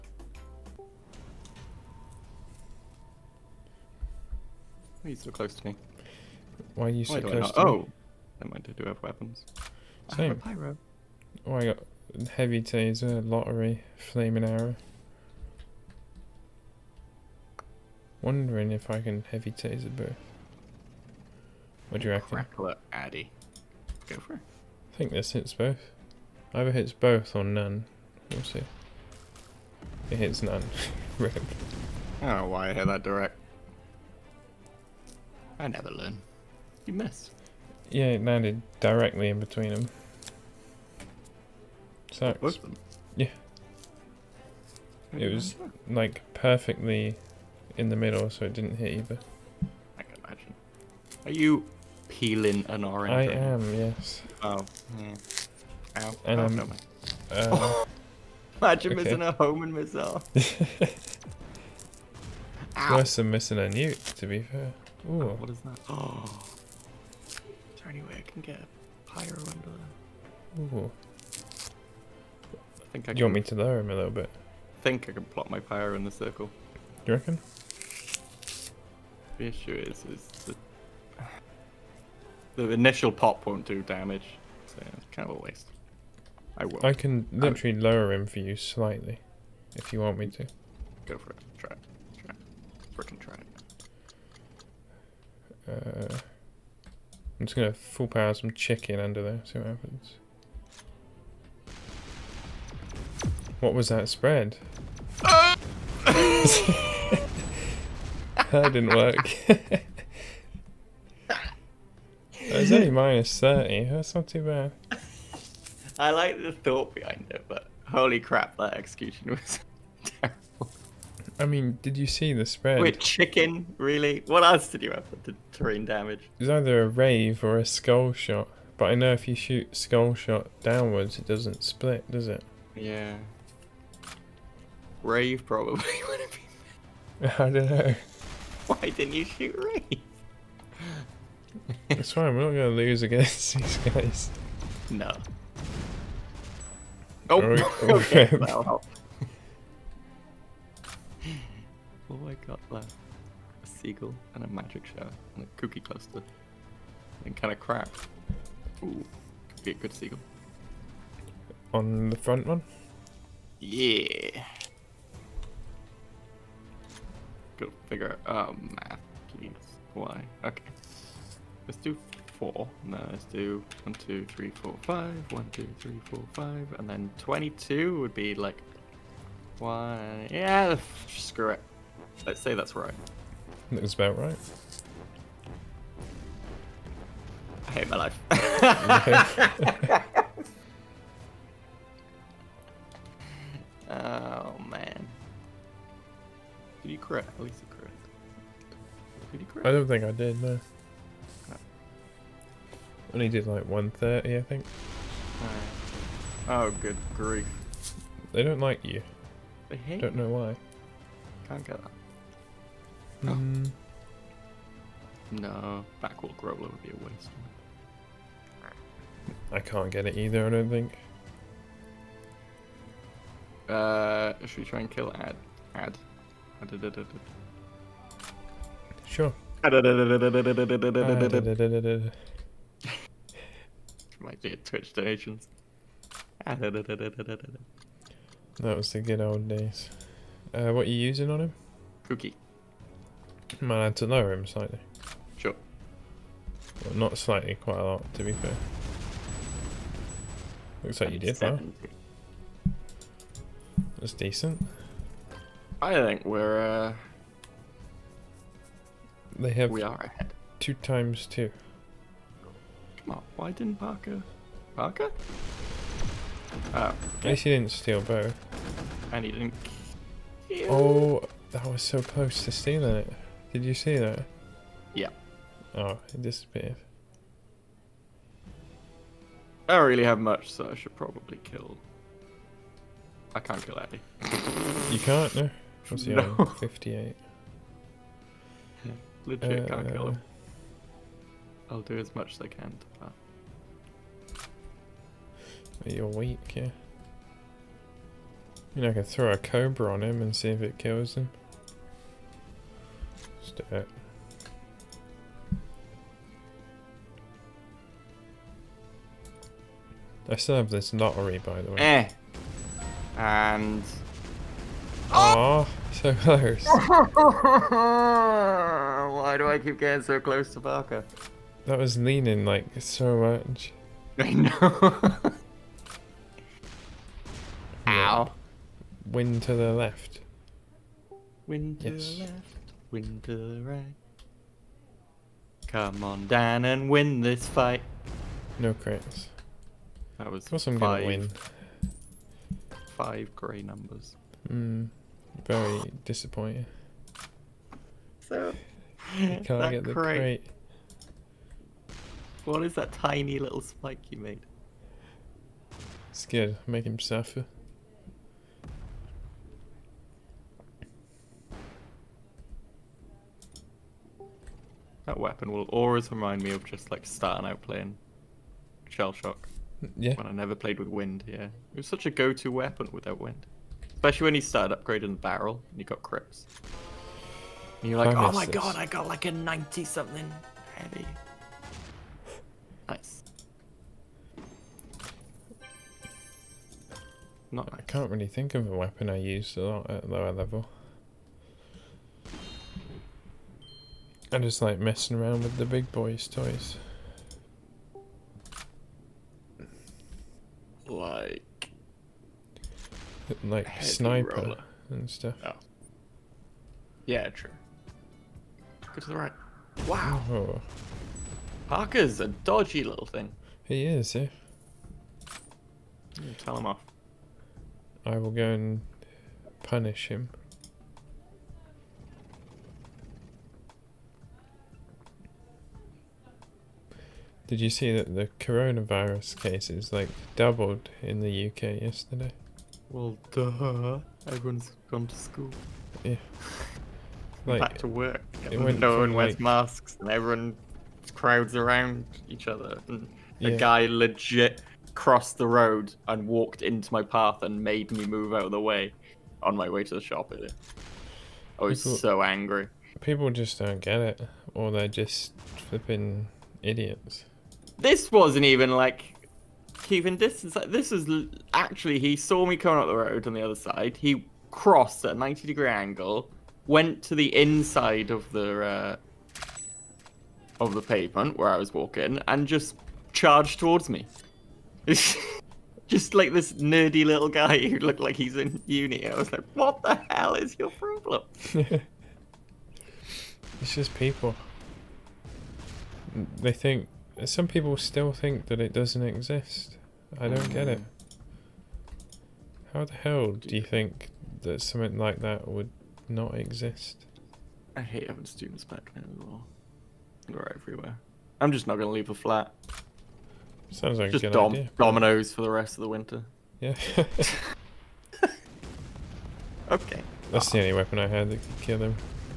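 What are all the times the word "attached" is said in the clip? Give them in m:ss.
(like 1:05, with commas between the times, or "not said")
not said.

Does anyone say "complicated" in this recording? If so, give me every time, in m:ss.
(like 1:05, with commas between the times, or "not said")
not said.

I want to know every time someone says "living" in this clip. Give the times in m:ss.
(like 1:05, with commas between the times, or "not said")
not said.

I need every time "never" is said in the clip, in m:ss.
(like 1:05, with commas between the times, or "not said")
0:08, 0:35, 6:10.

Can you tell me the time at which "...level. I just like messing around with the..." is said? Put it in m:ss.
6:30.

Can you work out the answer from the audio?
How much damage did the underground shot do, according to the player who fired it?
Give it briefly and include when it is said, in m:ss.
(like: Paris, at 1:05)
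30, at 1:52.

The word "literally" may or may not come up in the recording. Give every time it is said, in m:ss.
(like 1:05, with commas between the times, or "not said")
1:27.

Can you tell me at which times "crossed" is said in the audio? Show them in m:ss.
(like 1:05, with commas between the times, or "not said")
7:24, 7:44.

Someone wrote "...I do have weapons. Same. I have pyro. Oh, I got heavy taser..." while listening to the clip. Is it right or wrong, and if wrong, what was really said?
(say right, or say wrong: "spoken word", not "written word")
right.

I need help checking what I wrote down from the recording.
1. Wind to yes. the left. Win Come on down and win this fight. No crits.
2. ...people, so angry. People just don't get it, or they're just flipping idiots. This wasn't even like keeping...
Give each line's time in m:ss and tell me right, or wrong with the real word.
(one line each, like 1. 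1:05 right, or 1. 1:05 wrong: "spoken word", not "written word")
1. 5:31 right
2. 7:31 right.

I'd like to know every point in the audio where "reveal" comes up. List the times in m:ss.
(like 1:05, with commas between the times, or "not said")
not said.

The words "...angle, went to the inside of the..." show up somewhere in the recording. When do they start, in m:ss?
7:45.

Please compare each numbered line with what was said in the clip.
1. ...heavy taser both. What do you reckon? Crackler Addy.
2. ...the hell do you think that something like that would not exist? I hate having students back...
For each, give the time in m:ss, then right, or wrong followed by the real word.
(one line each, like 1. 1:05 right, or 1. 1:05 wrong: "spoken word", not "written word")
1. 0:19 right
2. 8:12 right.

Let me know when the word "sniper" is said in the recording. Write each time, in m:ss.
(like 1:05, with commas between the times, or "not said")
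6:43.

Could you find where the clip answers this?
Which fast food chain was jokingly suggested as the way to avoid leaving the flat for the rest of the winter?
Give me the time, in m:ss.
8:24.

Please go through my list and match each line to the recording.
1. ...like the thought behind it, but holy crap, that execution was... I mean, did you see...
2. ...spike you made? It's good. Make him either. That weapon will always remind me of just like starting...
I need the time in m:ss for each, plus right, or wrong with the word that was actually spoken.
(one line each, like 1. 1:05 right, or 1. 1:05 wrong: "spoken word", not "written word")
1. 1:56 right
2. 5:53 wrong: "suffer", not "either".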